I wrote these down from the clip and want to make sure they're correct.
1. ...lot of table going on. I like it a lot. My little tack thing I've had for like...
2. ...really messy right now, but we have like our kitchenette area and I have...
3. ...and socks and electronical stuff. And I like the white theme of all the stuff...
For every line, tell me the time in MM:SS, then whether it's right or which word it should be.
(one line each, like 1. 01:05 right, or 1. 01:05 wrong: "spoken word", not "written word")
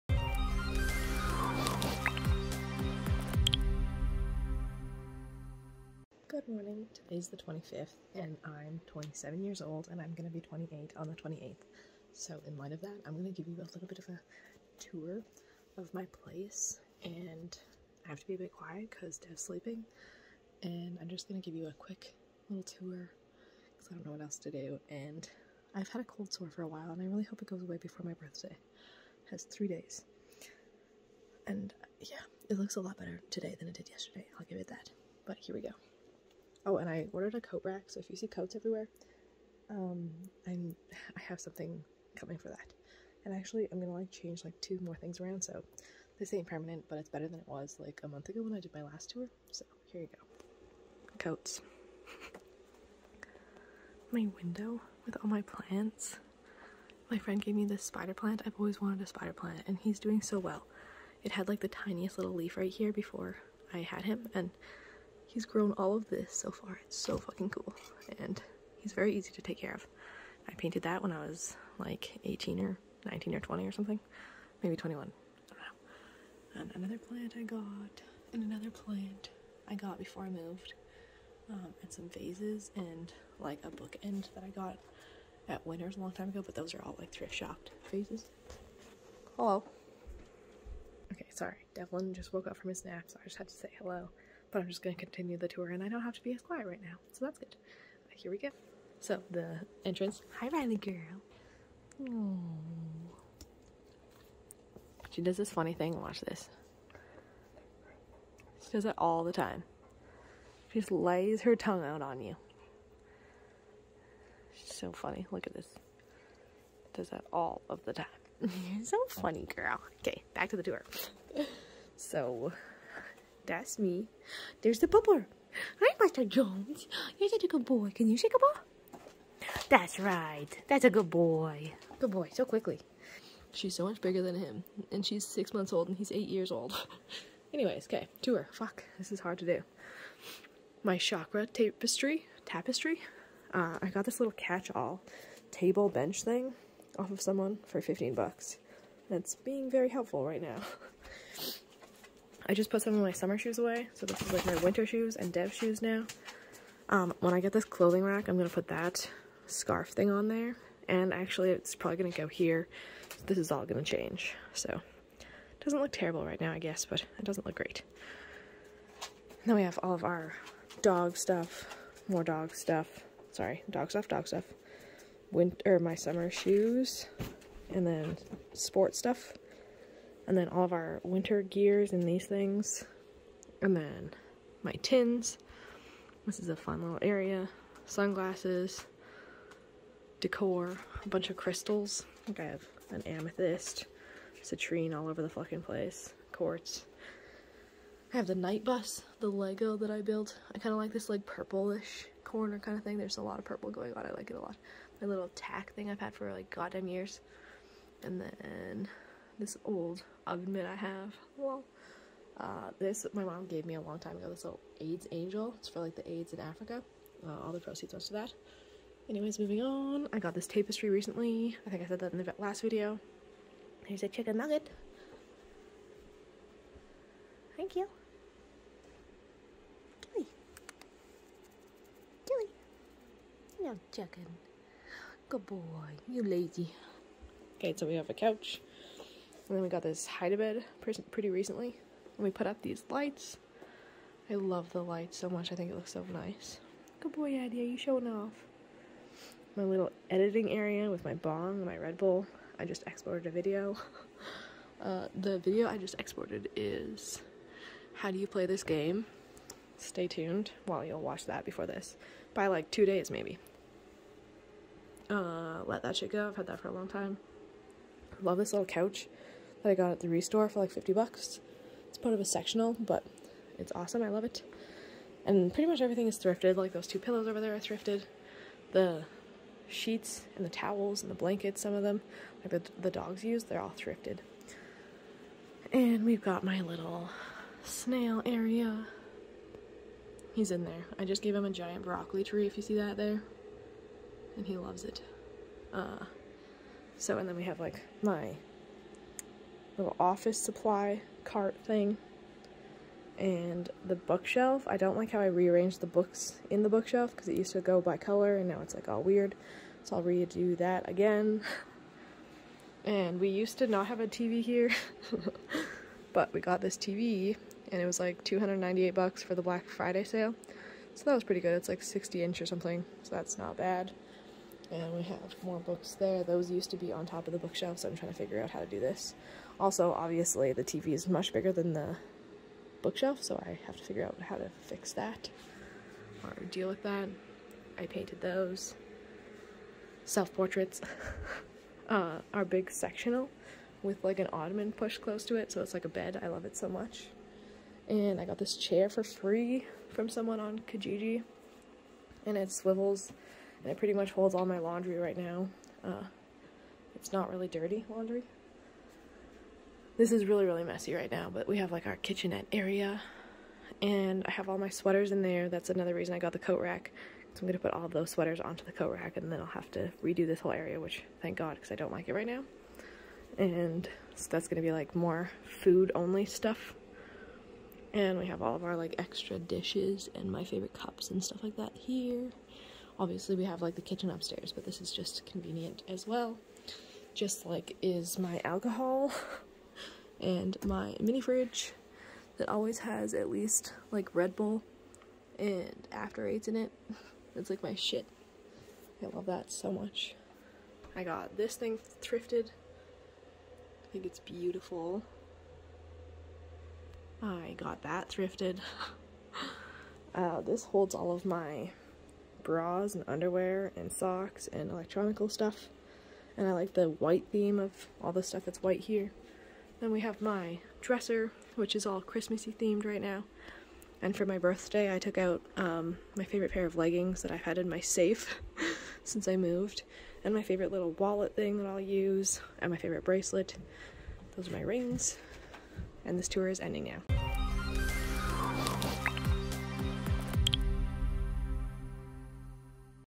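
1. 03:23 wrong: "purple", not "table"
2. 06:00 right
3. 06:53 right.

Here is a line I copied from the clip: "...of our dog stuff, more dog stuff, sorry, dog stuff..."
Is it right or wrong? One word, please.
right.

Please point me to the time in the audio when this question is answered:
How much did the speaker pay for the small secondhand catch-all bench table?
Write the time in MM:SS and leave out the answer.
02:27.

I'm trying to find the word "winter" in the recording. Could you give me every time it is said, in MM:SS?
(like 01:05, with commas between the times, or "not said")
02:34, 02:55, 03:01.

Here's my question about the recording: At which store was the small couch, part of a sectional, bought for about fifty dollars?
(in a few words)
the Restore.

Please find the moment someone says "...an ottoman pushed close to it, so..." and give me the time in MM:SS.
05:44.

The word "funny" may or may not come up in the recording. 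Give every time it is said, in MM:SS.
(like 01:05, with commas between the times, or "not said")
01:45, 01:54, 01:59.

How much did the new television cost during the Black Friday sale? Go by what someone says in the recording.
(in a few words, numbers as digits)
298 bucks.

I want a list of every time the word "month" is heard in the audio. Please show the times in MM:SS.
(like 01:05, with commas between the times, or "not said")
00:48, 02:15.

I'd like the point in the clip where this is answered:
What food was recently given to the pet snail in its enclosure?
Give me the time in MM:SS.
04:51.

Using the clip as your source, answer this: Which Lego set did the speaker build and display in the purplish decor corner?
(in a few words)
The Knight Bus.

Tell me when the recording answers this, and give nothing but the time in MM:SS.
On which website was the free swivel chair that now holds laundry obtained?
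05:50.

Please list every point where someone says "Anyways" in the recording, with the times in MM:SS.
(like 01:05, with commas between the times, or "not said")
02:17, 03:39.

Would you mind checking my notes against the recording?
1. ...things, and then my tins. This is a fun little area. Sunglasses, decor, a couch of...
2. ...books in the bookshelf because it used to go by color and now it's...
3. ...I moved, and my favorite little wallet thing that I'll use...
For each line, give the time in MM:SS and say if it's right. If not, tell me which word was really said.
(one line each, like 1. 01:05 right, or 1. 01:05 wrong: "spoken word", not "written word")
1. 03:02 wrong: "bunch", not "couch"
2. 05:05 right
3. 07:09 right.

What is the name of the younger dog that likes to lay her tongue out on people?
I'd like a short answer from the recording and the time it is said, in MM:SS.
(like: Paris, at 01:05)
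Riley, at 01:40.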